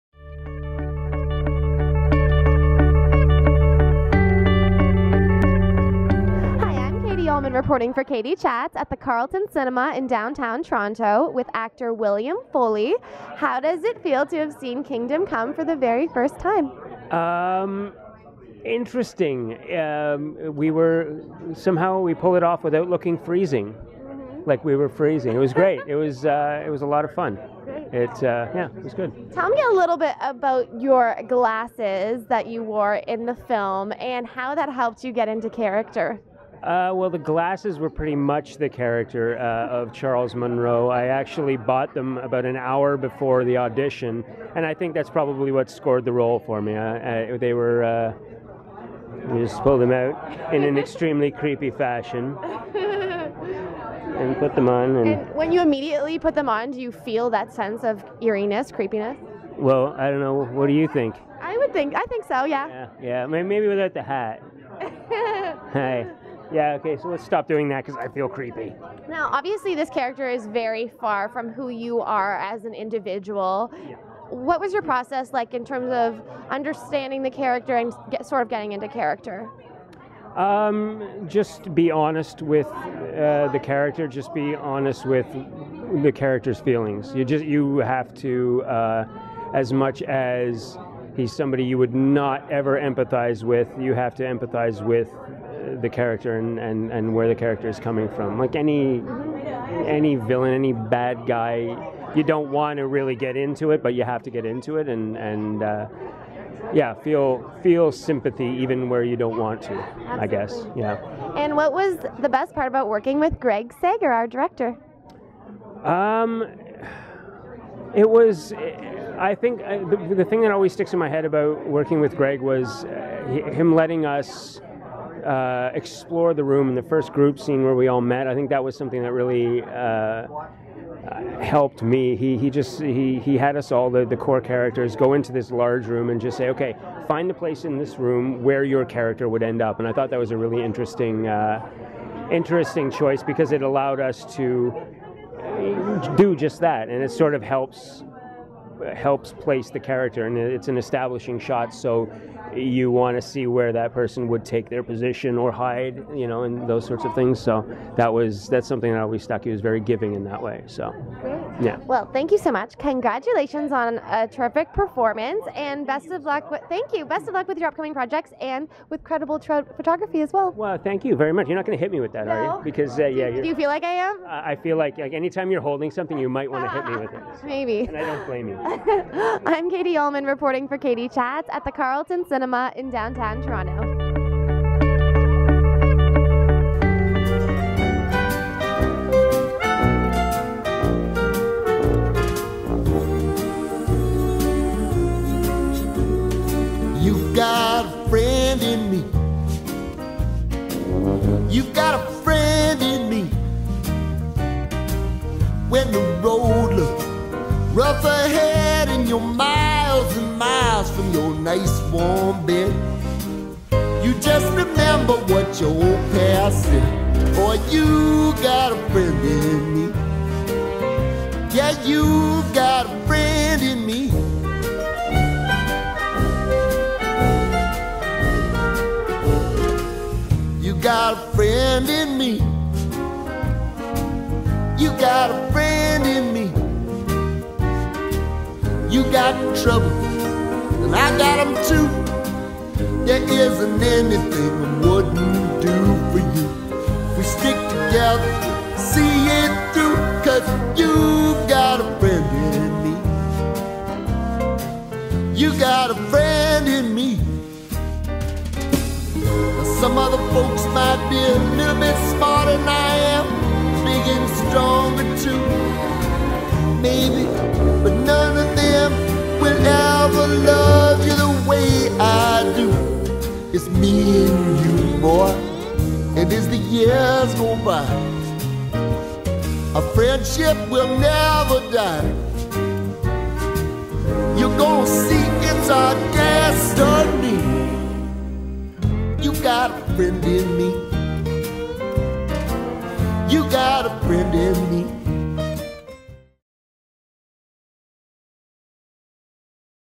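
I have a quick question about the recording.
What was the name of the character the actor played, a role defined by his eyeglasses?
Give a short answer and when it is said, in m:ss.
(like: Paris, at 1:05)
Charles Monroe, at 0:39.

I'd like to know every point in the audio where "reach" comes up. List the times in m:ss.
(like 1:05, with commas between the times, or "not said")
not said.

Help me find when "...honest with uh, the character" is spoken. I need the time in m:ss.
1:21.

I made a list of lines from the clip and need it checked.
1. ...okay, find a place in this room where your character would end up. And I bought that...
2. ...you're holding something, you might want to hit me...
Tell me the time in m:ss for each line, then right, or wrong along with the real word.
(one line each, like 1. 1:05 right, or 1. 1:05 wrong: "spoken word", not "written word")
1. 2:16 wrong: "thought", not "bought"
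2. 2:55 right.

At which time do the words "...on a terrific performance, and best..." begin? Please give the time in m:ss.
2:43.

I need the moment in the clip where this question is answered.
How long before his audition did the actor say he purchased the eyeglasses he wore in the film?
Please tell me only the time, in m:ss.
0:42.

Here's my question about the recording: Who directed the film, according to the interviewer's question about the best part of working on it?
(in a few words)
Greg Sager.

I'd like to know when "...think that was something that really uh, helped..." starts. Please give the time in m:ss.
2:08.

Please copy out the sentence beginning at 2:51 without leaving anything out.
You're not going to hit me with that, no.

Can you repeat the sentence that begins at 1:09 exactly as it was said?
Now, obviously, this character is very far from who you are as an individual.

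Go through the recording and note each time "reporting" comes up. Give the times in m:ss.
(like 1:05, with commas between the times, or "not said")
0:07, 3:00.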